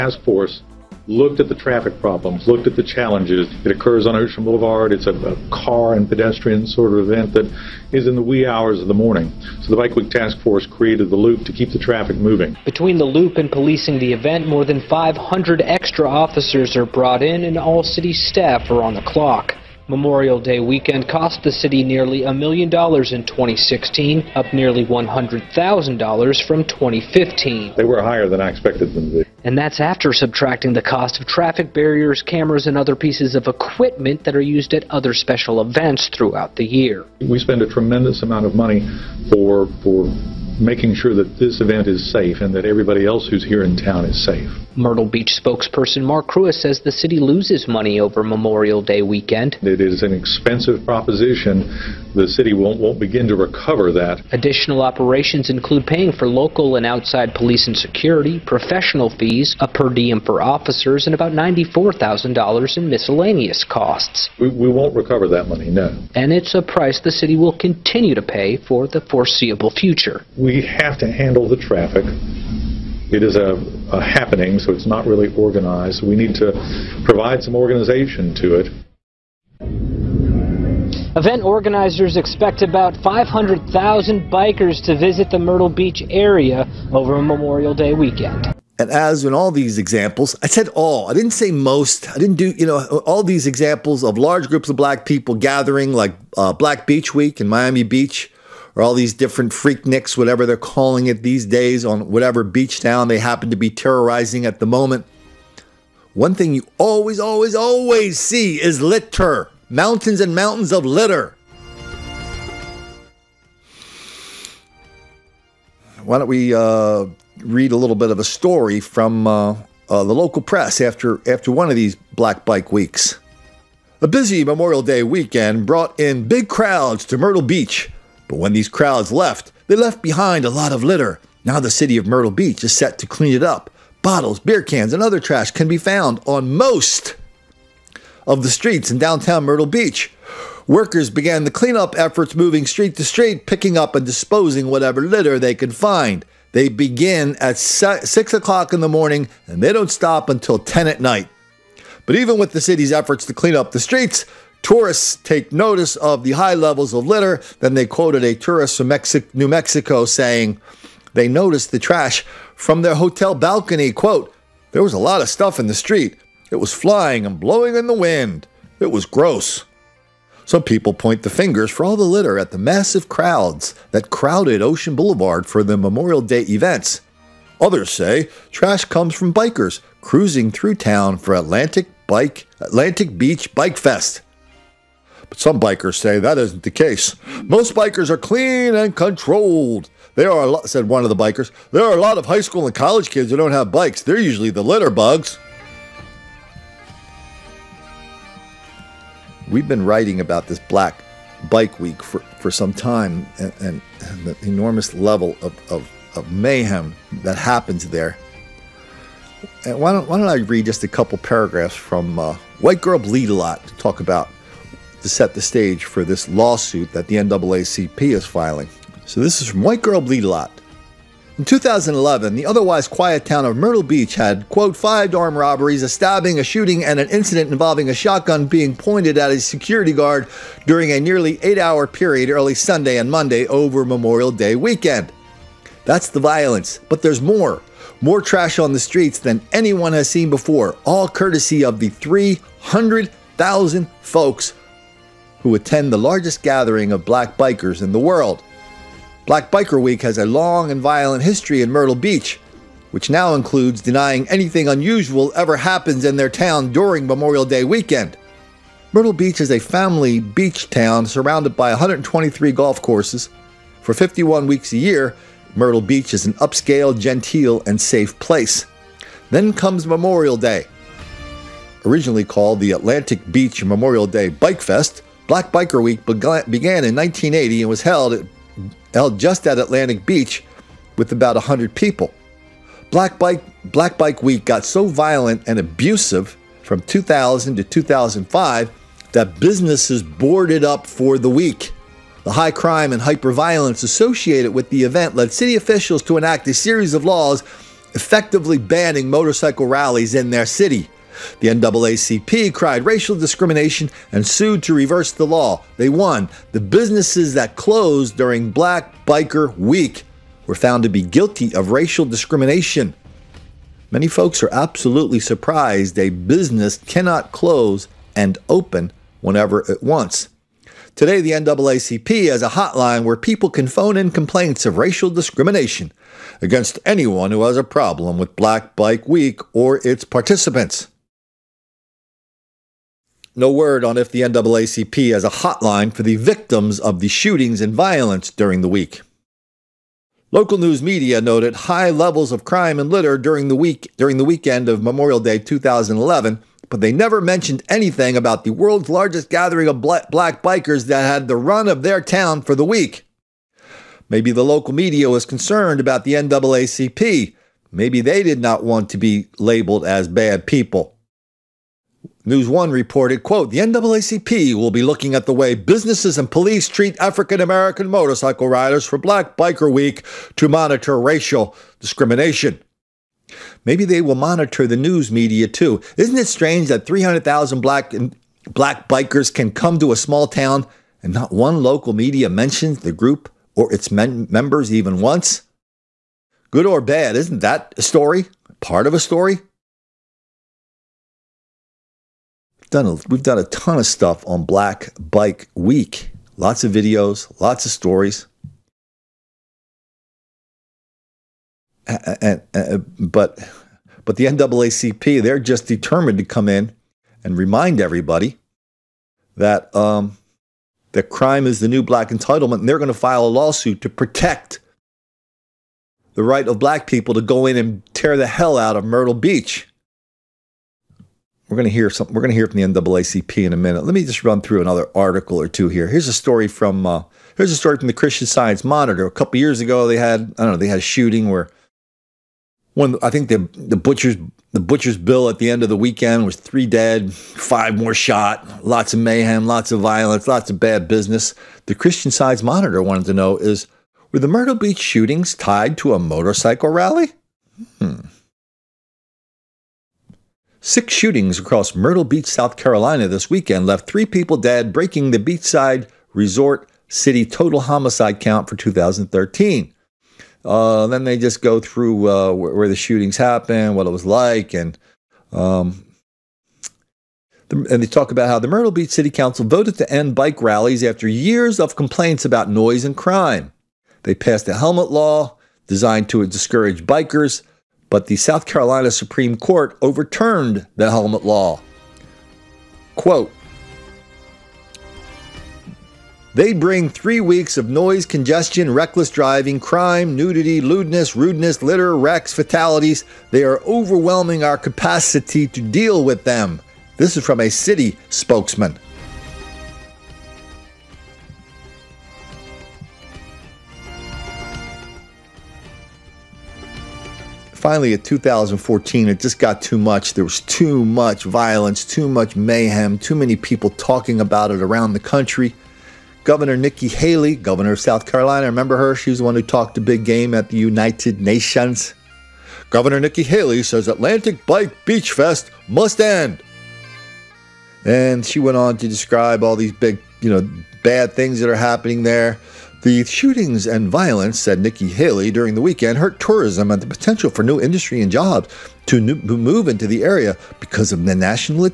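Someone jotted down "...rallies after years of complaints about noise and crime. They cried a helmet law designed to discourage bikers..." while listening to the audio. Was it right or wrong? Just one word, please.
wrong.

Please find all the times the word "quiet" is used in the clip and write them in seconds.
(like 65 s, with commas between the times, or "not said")
222 s.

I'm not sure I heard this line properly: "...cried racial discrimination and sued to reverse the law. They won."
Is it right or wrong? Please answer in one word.
right.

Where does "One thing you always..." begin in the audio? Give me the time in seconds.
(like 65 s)
106 s.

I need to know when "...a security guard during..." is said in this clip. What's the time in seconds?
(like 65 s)
229 s.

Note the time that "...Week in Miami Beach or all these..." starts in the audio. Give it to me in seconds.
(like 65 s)
97 s.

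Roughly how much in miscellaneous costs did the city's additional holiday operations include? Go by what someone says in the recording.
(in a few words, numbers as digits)
$94,000.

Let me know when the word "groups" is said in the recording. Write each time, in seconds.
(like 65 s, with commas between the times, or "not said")
94 s, 382 s.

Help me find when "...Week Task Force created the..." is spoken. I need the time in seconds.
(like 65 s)
9 s.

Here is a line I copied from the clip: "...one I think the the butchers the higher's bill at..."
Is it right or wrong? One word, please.
wrong.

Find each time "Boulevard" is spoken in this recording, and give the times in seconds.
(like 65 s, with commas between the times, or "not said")
4 s, 174 s.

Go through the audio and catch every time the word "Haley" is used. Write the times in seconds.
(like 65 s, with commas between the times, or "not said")
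516 s, 523 s, 534 s.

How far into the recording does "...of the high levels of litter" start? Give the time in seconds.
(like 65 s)
155 s.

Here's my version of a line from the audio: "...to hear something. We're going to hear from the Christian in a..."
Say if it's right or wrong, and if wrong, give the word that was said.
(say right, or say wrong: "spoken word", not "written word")
wrong: "NAACP", not "Christian".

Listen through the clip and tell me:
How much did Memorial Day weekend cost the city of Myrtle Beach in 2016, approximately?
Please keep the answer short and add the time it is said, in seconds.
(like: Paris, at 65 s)
nearly a million dollars, at 21 s.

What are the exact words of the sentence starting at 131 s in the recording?
Now the city of Myrtle Beach is set to clean it up.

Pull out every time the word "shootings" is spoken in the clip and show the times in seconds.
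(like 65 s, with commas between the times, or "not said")
226 s, 337 s, 430 s, 444 s, 450 s, 462 s, 533 s.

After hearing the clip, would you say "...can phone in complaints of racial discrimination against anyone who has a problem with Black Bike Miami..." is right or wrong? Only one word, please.
wrong.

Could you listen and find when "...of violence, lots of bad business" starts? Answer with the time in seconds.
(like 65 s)
439 s.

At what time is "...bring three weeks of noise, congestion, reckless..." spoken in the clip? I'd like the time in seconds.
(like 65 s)
486 s.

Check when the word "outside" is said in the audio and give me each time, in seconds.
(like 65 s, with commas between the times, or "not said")
56 s.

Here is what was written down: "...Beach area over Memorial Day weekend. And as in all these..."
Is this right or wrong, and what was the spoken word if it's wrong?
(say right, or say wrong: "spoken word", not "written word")
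right.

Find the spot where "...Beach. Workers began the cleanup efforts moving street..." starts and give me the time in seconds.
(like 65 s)
139 s.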